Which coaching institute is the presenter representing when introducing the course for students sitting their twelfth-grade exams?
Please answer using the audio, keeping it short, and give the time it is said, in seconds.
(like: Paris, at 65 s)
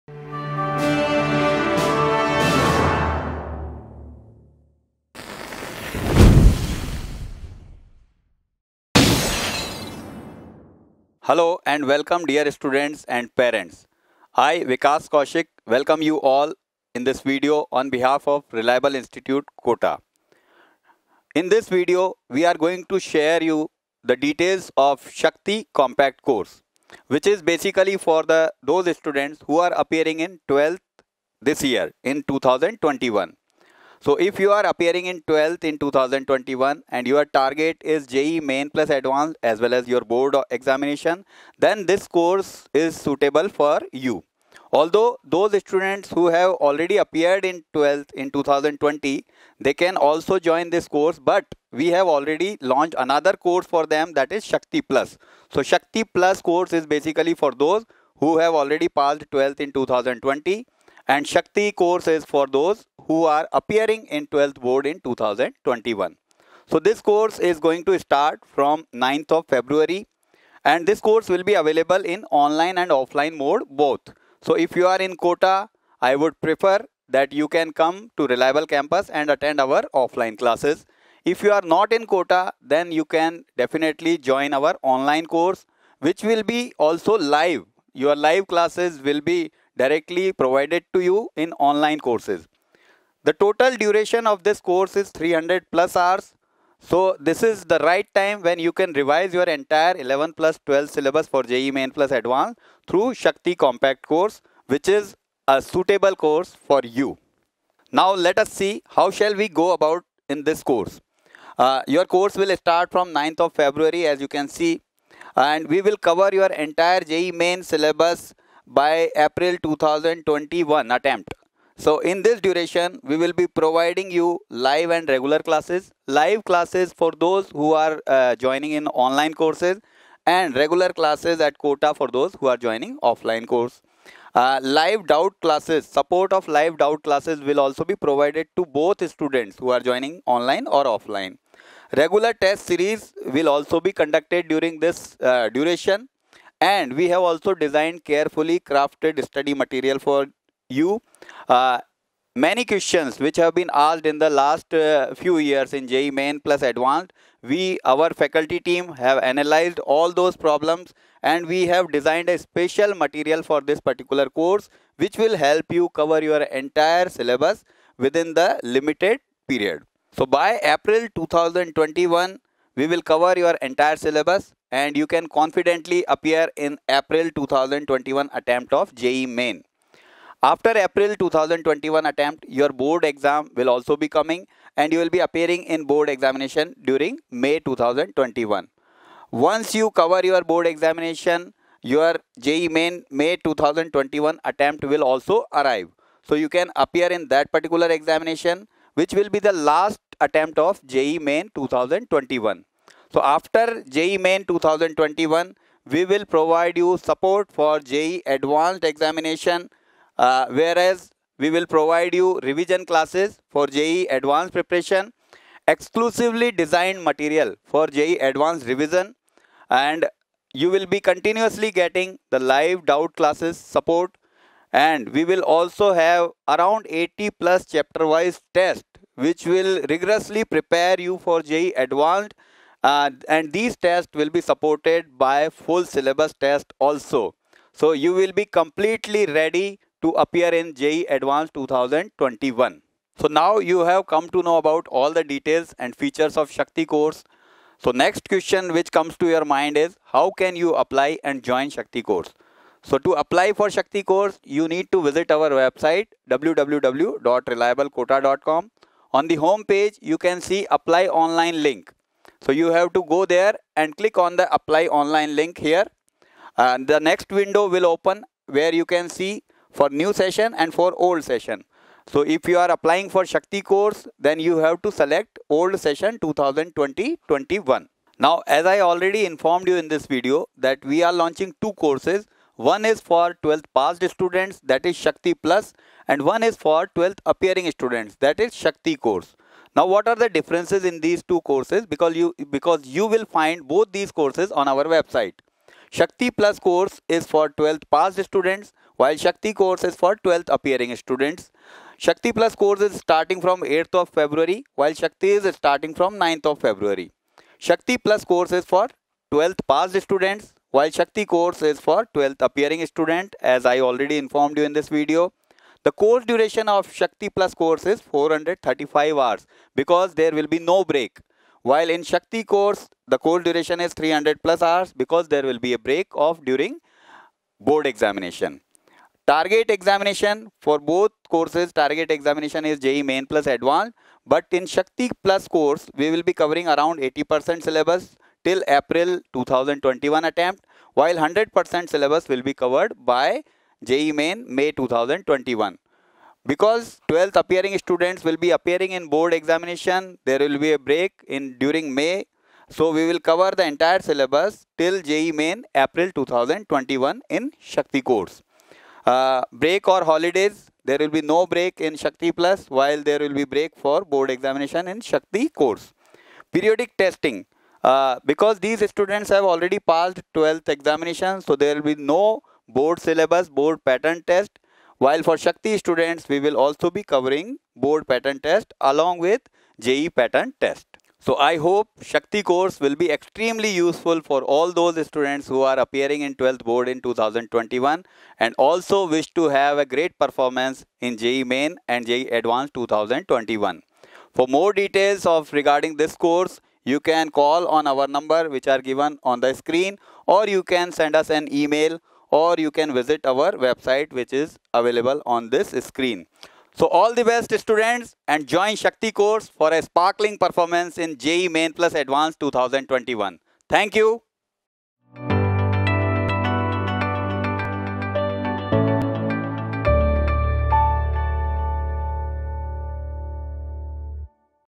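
Reliable Institute Kota, at 18 s.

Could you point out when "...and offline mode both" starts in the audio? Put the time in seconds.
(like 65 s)
72 s.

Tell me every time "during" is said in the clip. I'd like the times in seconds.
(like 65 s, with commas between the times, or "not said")
144 s, 186 s, 326 s, 351 s.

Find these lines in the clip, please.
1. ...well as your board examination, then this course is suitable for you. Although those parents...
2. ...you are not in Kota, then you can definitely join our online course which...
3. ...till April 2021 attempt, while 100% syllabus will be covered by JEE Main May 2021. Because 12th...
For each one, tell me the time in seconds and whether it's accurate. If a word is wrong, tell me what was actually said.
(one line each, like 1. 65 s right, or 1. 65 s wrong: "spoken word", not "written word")
1. 39 s wrong: "students", not "parents"
2. 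81 s right
3. 338 s right.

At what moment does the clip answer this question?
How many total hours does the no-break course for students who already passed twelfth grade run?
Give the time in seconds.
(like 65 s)
318 s.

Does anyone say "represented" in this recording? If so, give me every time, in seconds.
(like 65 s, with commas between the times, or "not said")
not said.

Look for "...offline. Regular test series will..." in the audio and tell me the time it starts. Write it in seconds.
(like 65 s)
140 s.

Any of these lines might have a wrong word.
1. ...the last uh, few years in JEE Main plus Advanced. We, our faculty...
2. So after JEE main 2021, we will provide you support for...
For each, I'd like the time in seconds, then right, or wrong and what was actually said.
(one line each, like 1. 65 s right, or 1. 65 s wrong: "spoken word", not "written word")
1. 154 s right
2. 203 s right.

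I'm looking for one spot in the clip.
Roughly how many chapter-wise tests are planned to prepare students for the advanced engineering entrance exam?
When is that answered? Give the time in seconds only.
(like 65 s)
226 s.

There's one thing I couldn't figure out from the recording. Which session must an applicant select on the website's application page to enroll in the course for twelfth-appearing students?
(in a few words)
old session 2020-21.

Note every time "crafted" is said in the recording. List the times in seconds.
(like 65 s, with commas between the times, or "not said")
148 s.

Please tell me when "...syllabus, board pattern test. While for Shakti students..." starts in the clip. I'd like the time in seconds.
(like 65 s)
373 s.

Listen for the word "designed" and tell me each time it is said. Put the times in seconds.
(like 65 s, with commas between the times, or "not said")
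147 s, 161 s, 216 s.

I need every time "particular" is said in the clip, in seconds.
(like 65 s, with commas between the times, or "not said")
163 s, 197 s.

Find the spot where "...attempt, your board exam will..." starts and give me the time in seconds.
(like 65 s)
182 s.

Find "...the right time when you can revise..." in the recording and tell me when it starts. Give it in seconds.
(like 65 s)
97 s.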